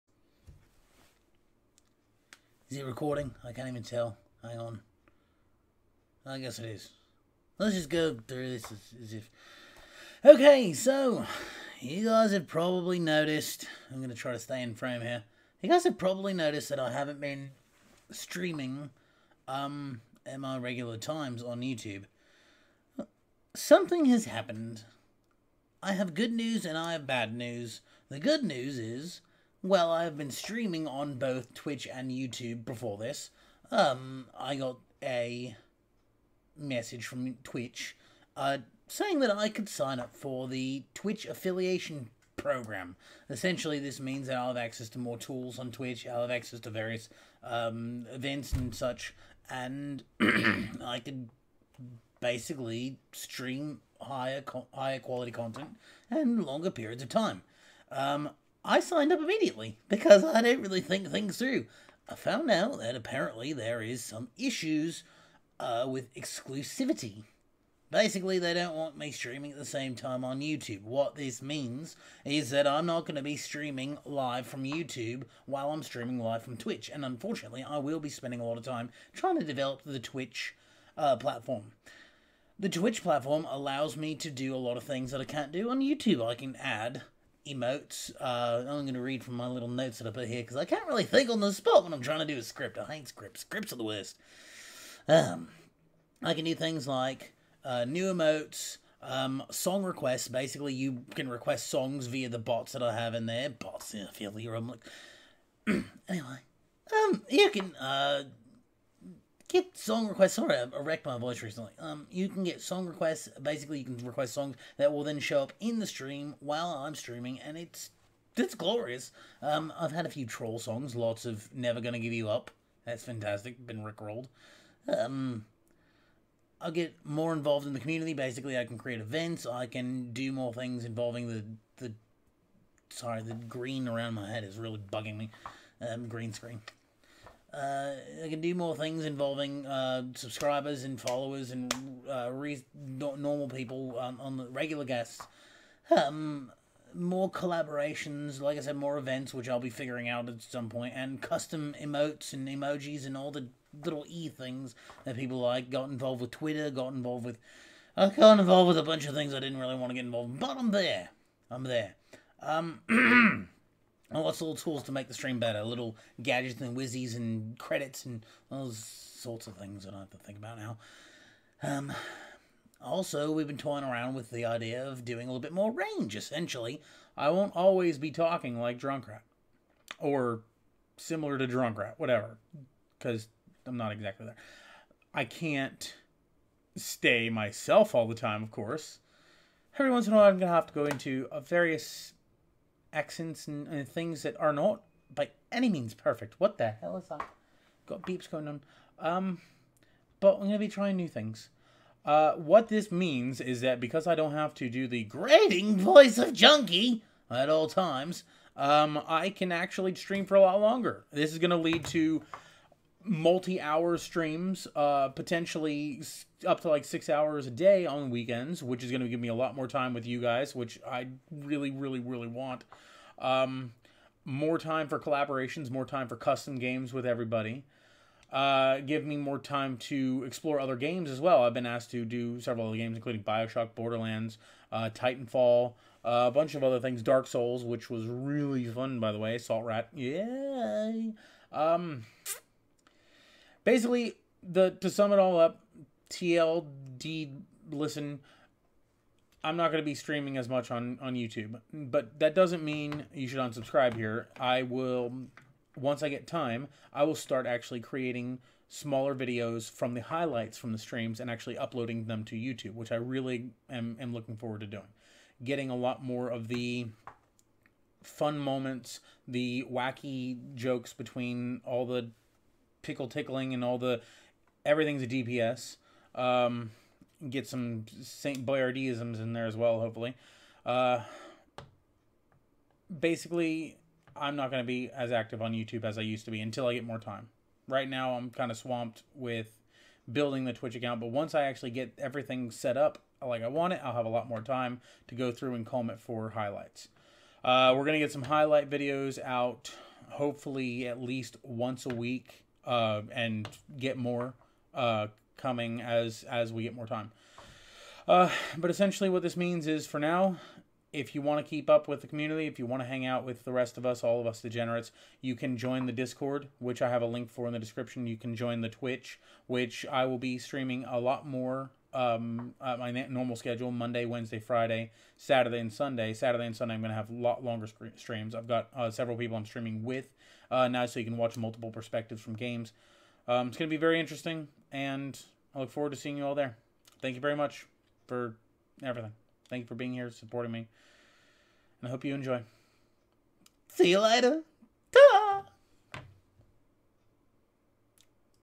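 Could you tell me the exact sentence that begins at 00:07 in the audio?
Let's just go through this as, as if.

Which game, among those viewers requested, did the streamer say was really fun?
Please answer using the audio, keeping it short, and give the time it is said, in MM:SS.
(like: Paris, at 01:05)
Dark Souls, at 03:57.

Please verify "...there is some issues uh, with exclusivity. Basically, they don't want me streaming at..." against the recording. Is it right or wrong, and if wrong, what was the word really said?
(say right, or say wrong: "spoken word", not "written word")
right.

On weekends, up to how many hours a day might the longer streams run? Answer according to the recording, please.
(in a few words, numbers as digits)
6.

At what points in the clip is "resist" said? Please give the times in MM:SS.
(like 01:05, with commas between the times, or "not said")
not said.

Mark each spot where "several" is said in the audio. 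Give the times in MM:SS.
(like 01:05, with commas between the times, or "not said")
03:52, 05:28.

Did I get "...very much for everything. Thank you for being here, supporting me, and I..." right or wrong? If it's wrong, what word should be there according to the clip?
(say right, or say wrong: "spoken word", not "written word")
right.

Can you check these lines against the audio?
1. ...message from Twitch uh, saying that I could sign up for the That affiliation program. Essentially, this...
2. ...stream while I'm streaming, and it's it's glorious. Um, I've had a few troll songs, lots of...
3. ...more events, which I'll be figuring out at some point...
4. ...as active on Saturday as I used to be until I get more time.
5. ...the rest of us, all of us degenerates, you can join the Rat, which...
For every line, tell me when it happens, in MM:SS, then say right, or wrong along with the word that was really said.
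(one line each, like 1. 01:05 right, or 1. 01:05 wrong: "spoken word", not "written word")
1. 00:36 wrong: "Twitch", not "That"
2. 01:55 right
3. 02:28 right
4. 04:44 wrong: "YouTube", not "Saturday"
5. 05:13 wrong: "Discord", not "Rat".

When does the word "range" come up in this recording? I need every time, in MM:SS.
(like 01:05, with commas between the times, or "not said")
02:55.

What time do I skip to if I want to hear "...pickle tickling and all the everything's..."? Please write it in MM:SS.
04:32.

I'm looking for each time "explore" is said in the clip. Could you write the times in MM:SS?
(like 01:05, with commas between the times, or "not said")
03:50.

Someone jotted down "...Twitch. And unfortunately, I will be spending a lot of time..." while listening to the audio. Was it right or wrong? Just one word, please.
right.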